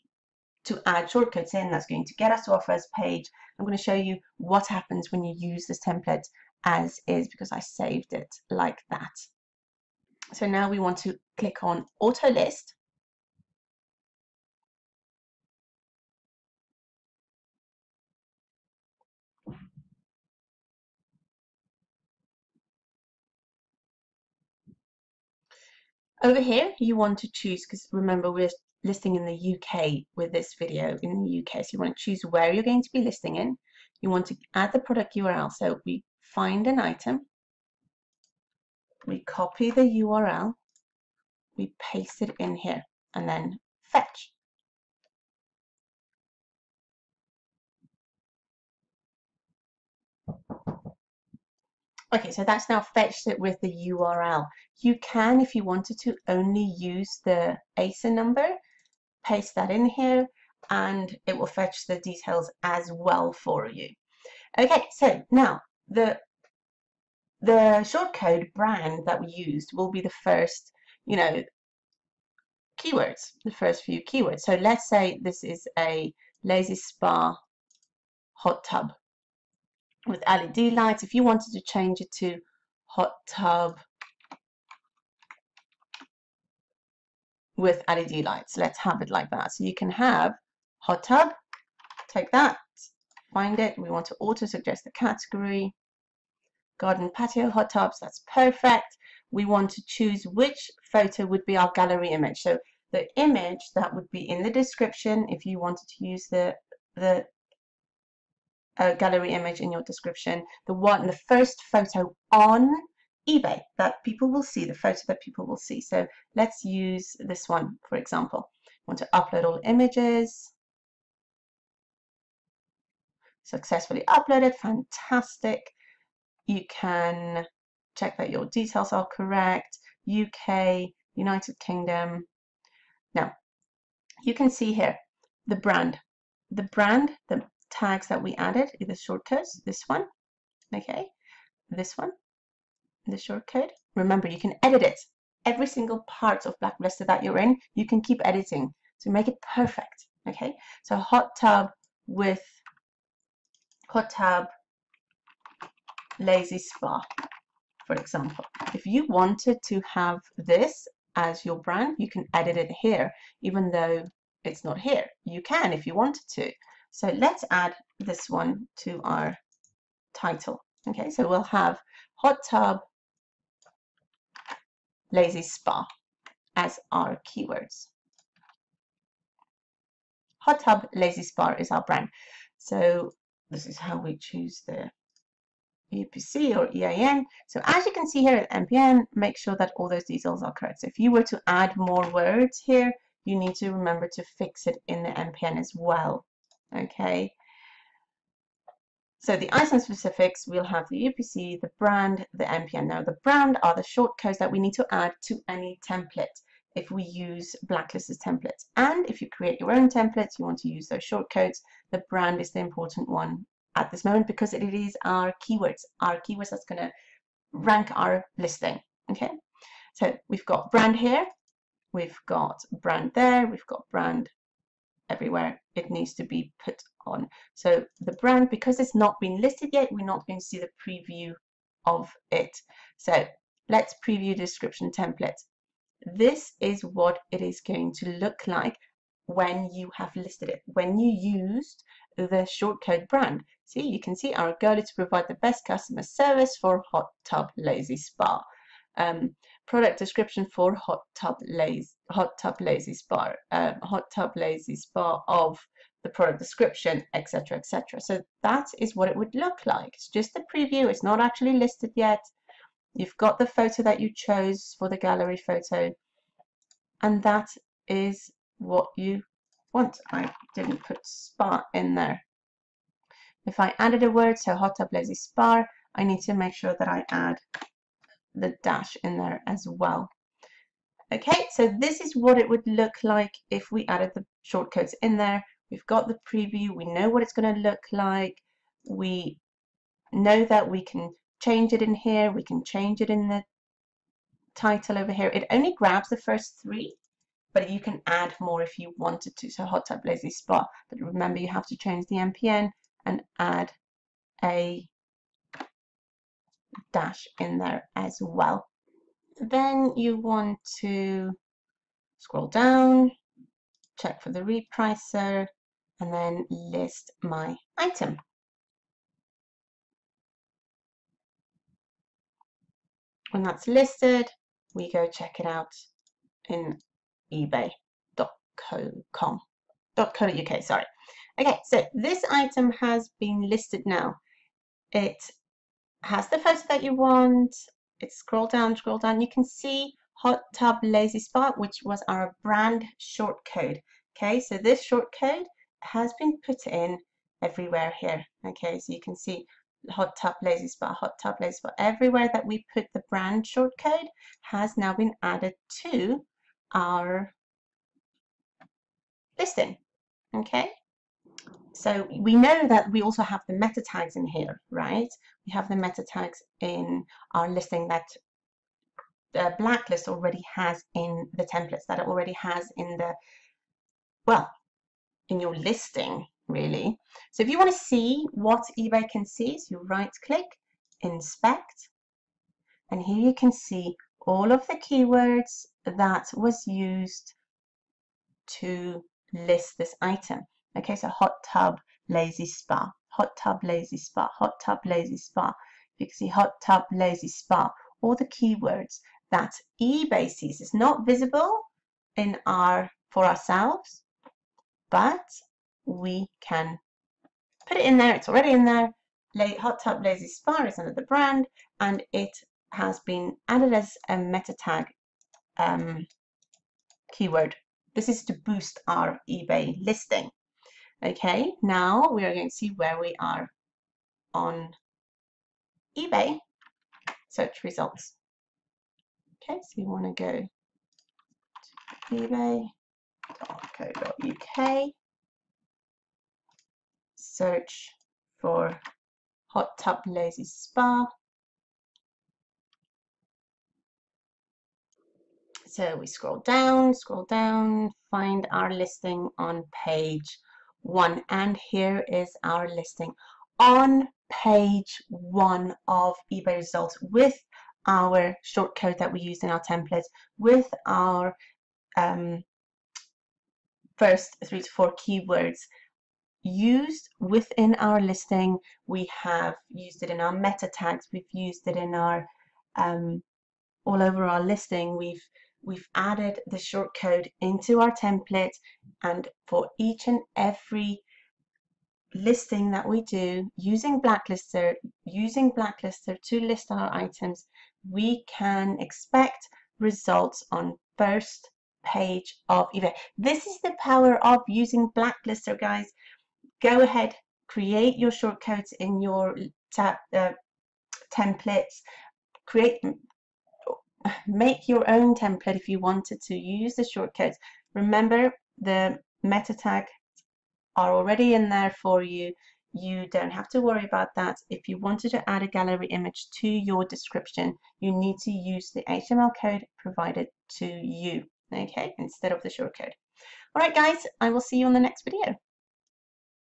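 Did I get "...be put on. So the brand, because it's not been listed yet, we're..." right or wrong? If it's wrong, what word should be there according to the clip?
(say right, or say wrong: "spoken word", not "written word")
right.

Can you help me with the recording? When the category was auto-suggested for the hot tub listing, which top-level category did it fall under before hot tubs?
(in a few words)
Garden patio.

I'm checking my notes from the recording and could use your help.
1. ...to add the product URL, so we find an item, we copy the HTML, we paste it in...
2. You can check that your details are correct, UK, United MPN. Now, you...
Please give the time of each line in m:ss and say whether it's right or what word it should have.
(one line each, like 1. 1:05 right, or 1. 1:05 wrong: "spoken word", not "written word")
1. 0:34 wrong: "URL", not "HTML"
2. 2:06 wrong: "Kingdom", not "MPN".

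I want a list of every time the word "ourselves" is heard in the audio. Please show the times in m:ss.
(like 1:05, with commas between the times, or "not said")
6:43.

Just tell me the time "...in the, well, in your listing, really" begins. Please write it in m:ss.
6:12.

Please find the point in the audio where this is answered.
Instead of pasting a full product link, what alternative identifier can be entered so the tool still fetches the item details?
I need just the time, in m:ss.
0:57.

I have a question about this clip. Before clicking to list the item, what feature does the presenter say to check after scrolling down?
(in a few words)
The repricer.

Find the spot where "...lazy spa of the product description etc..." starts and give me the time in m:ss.
4:14.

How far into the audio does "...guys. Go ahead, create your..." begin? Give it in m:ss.
8:15.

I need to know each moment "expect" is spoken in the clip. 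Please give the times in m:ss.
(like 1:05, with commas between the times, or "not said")
8:08.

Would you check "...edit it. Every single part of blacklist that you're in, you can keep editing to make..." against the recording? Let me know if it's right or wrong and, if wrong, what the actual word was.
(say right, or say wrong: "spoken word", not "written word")
right.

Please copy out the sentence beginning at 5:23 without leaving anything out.
When that's listed, we go check it out in eBay.co.uk.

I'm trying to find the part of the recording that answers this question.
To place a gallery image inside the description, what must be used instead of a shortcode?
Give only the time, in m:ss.
8:38.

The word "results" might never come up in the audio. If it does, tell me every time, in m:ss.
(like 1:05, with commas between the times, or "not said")
7:07, 7:36, 8:09.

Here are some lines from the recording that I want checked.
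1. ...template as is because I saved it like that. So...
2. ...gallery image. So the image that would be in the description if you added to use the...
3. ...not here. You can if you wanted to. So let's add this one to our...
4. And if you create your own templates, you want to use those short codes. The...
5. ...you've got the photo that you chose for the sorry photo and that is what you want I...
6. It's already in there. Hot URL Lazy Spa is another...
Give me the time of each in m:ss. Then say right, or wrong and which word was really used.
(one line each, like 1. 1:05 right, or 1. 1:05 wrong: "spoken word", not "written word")
1. 0:05 right
2. 1:41 wrong: "wanted", not "added"
3. 2:44 right
4. 3:28 right
5. 4:22 wrong: "gallery", not "sorry"
6. 6:48 wrong: "Tub", not "URL".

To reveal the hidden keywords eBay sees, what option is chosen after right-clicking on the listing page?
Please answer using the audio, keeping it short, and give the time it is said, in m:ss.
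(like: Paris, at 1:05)
Inspect, at 6:21.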